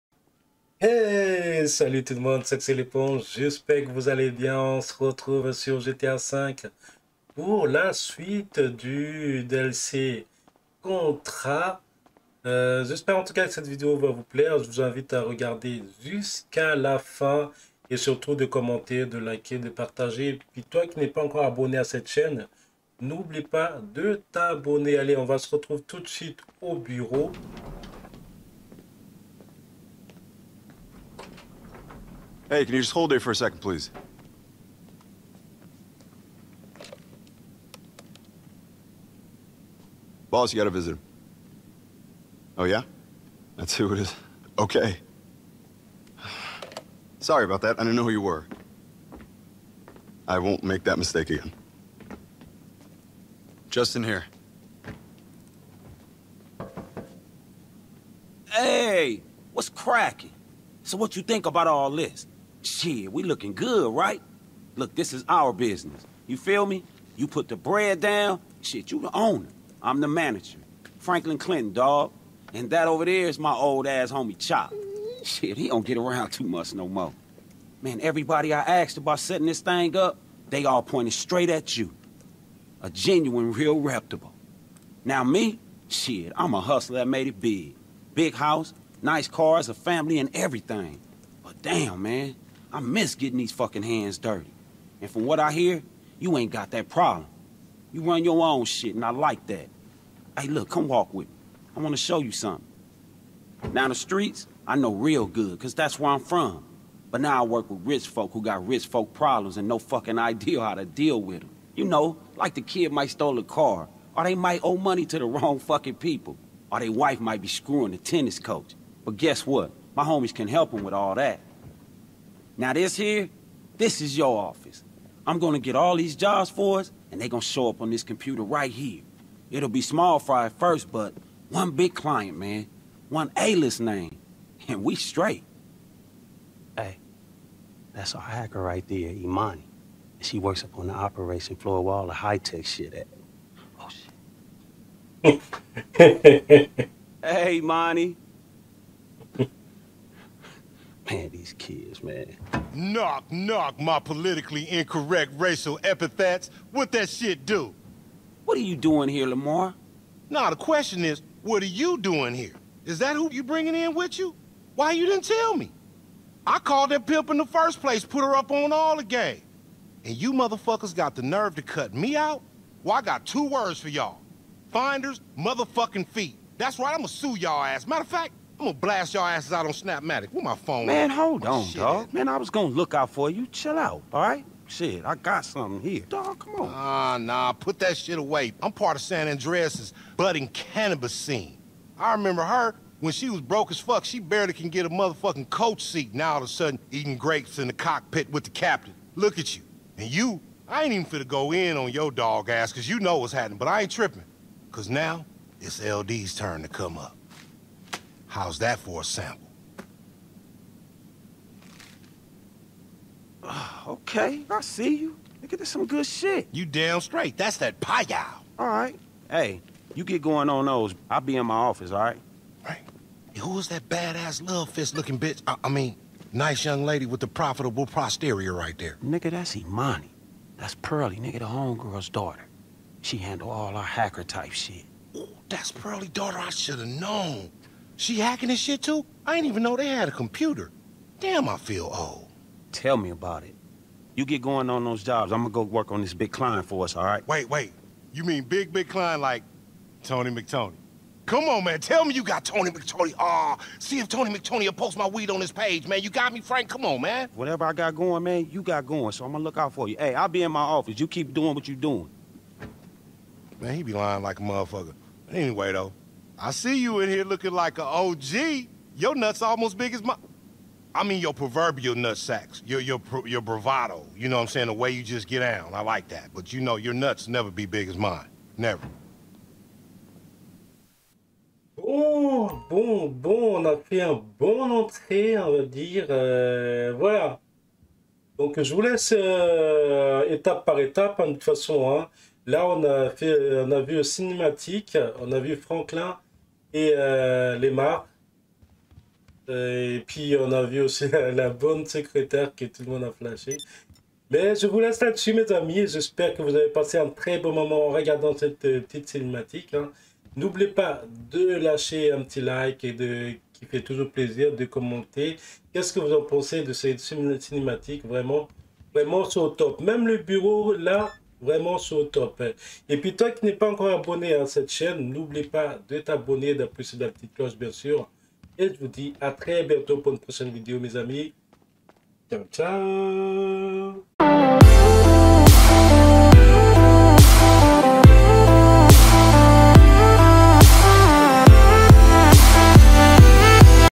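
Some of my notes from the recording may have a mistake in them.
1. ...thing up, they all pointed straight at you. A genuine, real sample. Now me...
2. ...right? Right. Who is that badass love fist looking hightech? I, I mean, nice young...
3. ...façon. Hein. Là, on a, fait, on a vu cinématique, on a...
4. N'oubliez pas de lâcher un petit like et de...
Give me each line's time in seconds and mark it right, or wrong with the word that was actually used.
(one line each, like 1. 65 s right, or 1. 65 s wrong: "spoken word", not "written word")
1. 79 s wrong: "reputable", not "sample"
2. 222 s wrong: "bitch", not "hightech"
3. 291 s right
4. 310 s right.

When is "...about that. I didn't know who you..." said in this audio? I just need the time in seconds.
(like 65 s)
47 s.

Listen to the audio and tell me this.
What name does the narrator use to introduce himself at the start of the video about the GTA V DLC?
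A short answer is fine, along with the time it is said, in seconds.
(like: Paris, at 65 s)
L'éponge, at 2 s.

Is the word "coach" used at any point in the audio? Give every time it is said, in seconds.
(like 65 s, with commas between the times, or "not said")
118 s, 195 s.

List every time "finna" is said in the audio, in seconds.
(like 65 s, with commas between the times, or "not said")
201 s.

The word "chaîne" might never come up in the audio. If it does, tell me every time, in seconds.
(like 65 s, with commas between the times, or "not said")
22 s, 324 s.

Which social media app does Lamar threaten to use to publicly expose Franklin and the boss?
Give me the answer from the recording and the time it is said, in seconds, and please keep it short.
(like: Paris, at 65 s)
Snapmatic, at 179 s.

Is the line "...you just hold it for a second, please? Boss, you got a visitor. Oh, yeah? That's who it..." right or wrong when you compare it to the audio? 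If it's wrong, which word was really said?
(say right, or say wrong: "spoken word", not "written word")
right.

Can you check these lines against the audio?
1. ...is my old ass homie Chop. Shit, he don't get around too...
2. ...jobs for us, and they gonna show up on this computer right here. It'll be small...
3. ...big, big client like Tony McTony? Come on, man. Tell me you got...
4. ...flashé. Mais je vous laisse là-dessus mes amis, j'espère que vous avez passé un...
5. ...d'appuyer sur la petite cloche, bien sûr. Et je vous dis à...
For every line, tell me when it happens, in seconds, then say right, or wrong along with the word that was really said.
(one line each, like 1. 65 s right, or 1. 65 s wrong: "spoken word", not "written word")
1. 73 s right
2. 126 s right
3. 248 s right
4. 303 s right
5. 326 s right.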